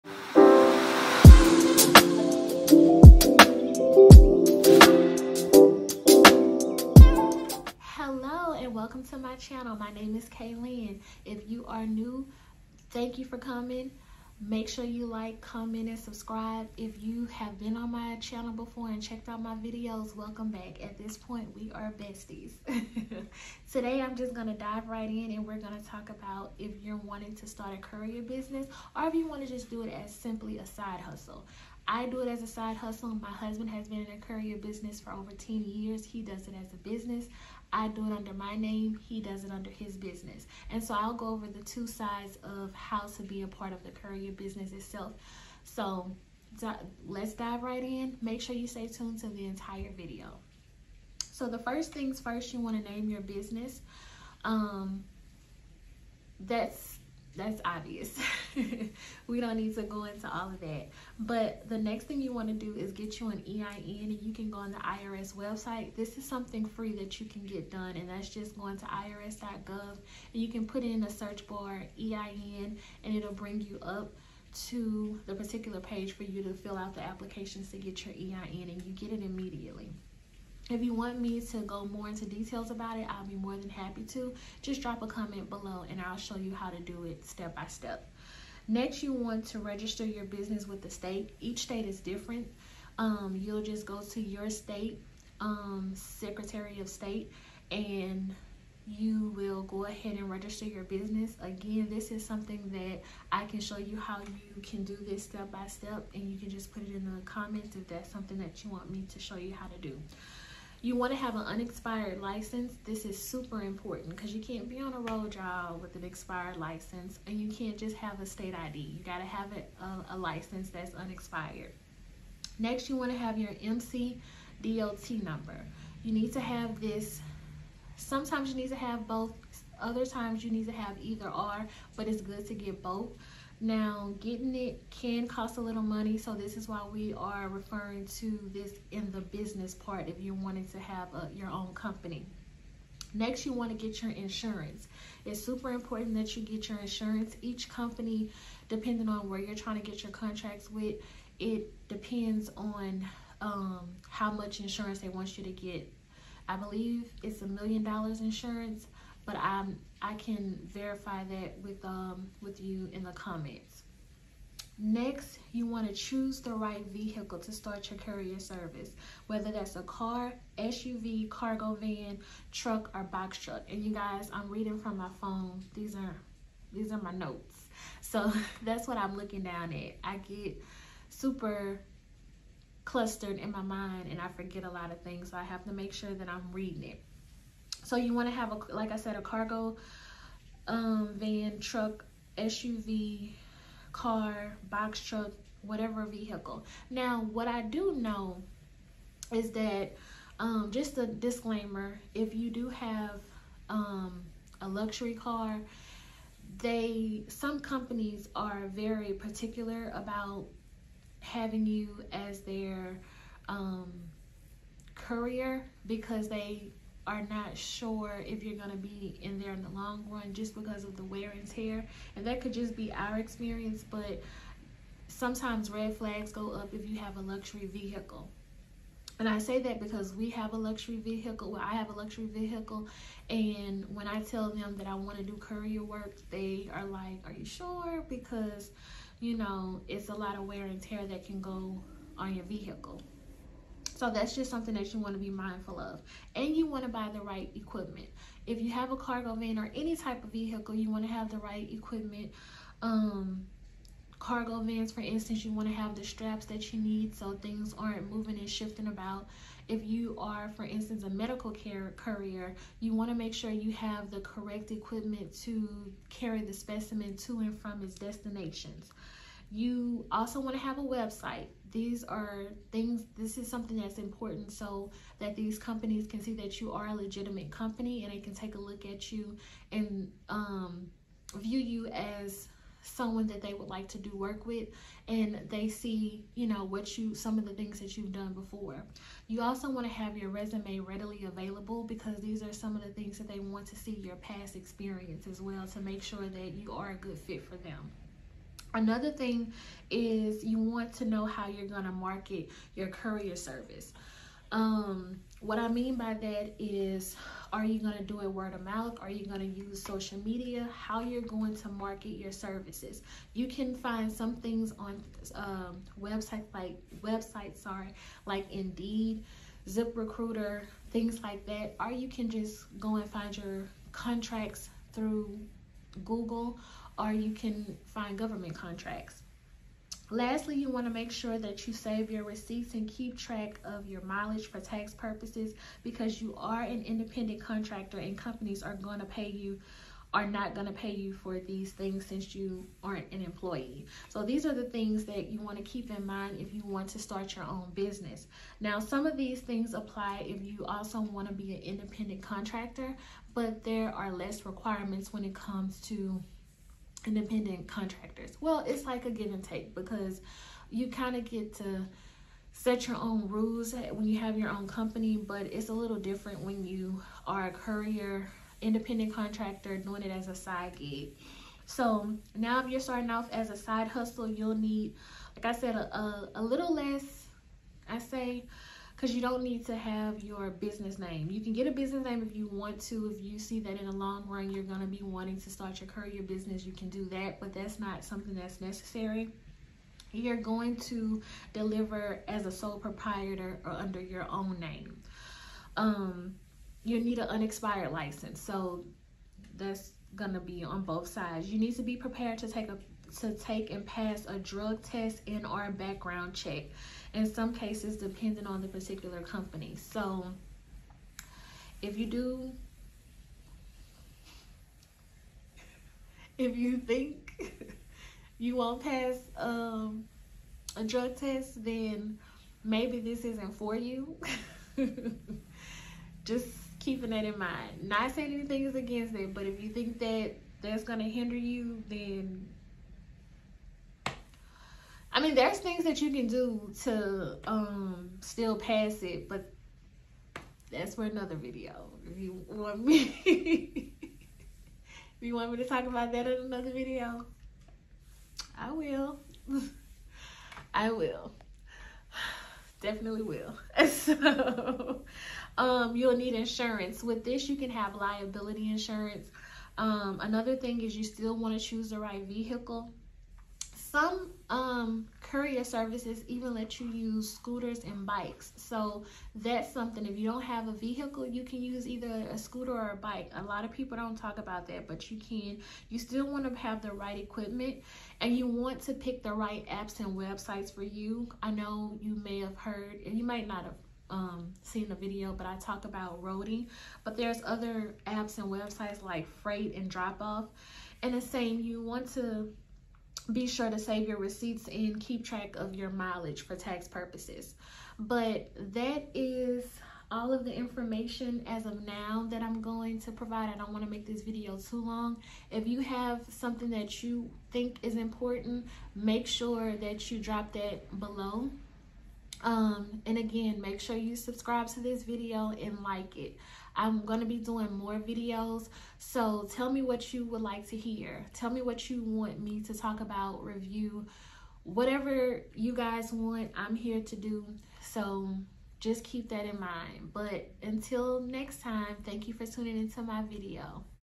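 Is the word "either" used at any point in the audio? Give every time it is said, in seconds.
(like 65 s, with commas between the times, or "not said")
130 s, 471 s.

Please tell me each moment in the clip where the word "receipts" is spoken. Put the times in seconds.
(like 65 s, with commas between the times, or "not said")
332 s, 494 s.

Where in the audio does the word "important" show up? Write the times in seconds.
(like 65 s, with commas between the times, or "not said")
113 s, 145 s, 273 s, 507 s.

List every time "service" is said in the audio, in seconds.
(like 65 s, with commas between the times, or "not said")
168 s, 303 s, 312 s, 465 s.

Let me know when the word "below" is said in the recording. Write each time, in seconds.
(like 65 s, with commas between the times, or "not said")
85 s, 510 s.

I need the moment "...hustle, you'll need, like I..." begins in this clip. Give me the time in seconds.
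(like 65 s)
373 s.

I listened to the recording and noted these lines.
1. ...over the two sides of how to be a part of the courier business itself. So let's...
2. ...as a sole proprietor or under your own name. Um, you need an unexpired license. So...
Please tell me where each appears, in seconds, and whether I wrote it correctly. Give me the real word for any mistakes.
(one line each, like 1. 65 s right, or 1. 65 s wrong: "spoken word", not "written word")
1. 41 s right
2. 392 s right.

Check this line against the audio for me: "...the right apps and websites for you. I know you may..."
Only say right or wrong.
right.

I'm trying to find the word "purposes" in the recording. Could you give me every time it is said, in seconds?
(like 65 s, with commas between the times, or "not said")
334 s, 496 s.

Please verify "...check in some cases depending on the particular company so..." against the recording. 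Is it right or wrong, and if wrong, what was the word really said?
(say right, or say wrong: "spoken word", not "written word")
right.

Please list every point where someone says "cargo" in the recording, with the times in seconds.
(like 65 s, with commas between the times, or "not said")
171 s, 189 s, 248 s, 254 s.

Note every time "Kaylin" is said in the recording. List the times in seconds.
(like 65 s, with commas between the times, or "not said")
10 s.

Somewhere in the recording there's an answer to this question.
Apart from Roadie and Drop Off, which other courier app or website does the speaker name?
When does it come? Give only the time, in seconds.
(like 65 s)
489 s.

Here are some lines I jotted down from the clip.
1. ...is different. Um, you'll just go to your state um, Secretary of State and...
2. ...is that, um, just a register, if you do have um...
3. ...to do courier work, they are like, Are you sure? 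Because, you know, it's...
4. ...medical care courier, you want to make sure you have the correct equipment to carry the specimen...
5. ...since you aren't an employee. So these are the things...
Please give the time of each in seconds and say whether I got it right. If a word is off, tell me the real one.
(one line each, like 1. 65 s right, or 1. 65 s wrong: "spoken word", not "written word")
1. 91 s right
2. 199 s wrong: "disclaimer", not "register"
3. 235 s right
4. 261 s right
5. 342 s right.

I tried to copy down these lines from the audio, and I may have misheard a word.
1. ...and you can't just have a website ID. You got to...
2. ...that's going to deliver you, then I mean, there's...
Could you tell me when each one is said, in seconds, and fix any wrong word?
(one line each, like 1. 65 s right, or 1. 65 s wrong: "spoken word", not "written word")
1. 117 s wrong: "state", not "website"
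2. 430 s wrong: "hinder", not "deliver".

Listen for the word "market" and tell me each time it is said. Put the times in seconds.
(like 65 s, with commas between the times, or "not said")
301 s, 311 s.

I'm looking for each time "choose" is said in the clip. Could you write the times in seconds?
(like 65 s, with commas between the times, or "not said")
165 s, 461 s.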